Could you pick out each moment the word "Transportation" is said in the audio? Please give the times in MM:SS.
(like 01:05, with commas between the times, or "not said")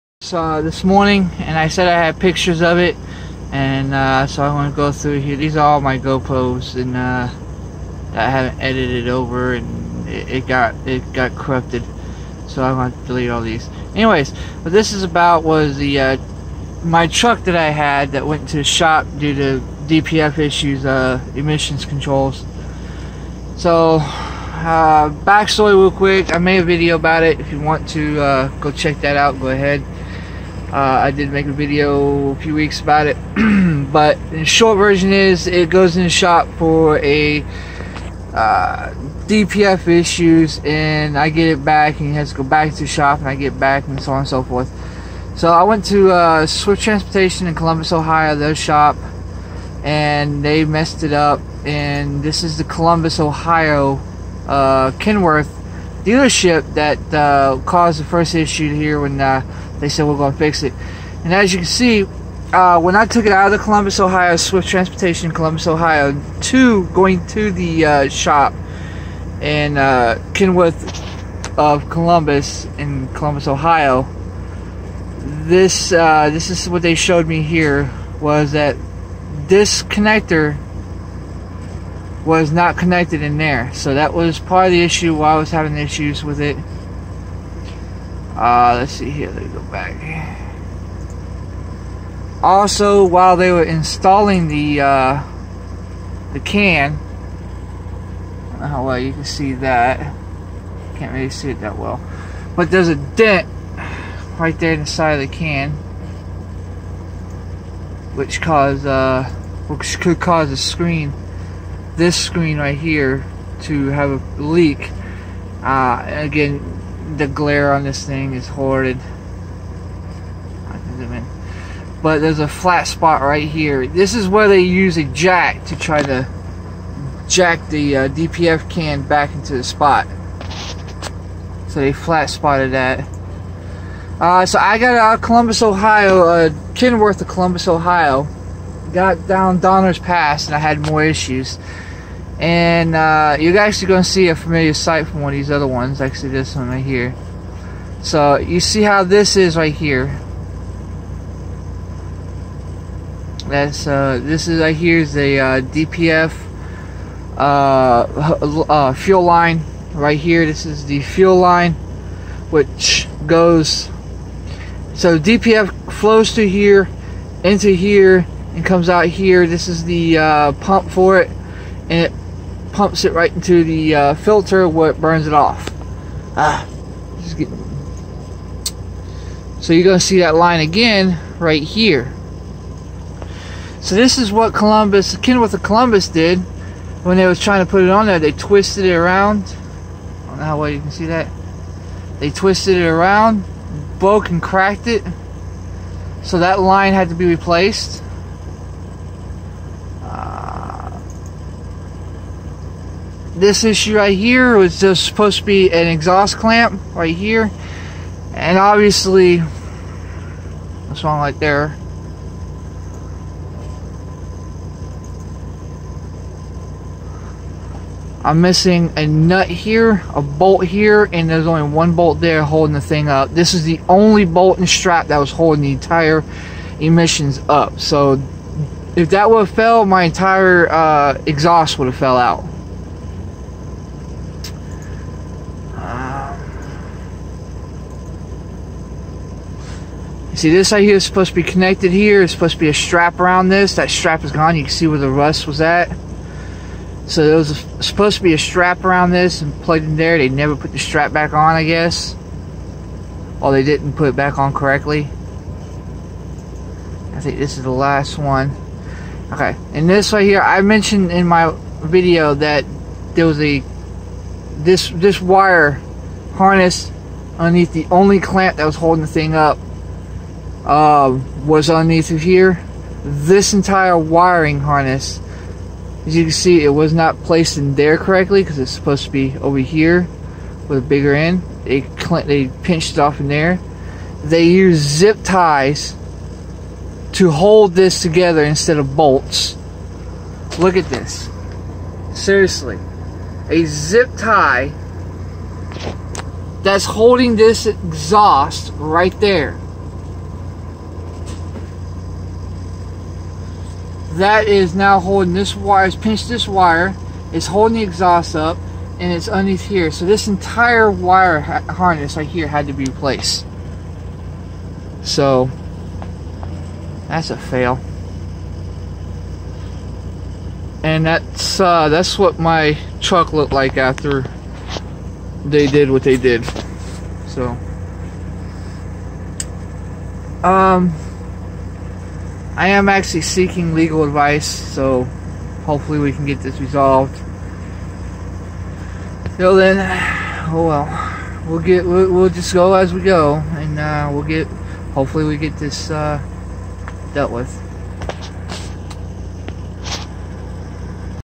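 00:46, 01:04.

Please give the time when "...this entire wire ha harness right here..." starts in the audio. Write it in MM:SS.
05:10.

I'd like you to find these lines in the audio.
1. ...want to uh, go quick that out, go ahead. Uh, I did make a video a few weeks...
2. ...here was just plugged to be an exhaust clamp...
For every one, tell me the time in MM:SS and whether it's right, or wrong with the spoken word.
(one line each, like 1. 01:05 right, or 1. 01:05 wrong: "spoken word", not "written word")
1. 00:27 wrong: "check", not "quick"
2. 03:24 wrong: "supposed", not "plugged".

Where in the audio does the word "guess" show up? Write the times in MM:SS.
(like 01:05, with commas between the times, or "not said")
04:11.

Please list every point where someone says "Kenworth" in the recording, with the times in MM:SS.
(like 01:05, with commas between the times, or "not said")
00:55, 01:10, 02:16, 03:05.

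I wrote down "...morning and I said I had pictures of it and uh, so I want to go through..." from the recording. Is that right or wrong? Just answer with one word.
right.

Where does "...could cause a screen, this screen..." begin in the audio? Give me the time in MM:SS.
01:49.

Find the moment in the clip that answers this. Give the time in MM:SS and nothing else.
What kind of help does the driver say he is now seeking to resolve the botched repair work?
05:33.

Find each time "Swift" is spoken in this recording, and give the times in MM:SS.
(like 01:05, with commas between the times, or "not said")
00:46, 01:04.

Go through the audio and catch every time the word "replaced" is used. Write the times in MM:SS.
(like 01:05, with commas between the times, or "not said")
03:17, 05:12.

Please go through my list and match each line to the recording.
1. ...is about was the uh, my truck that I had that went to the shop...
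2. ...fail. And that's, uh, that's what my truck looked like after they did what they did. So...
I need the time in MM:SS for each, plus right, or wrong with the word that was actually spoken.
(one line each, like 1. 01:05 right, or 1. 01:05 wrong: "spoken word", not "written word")
1. 00:14 right
2. 05:17 right.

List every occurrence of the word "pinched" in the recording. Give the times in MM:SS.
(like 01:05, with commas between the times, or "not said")
04:42, 05:05.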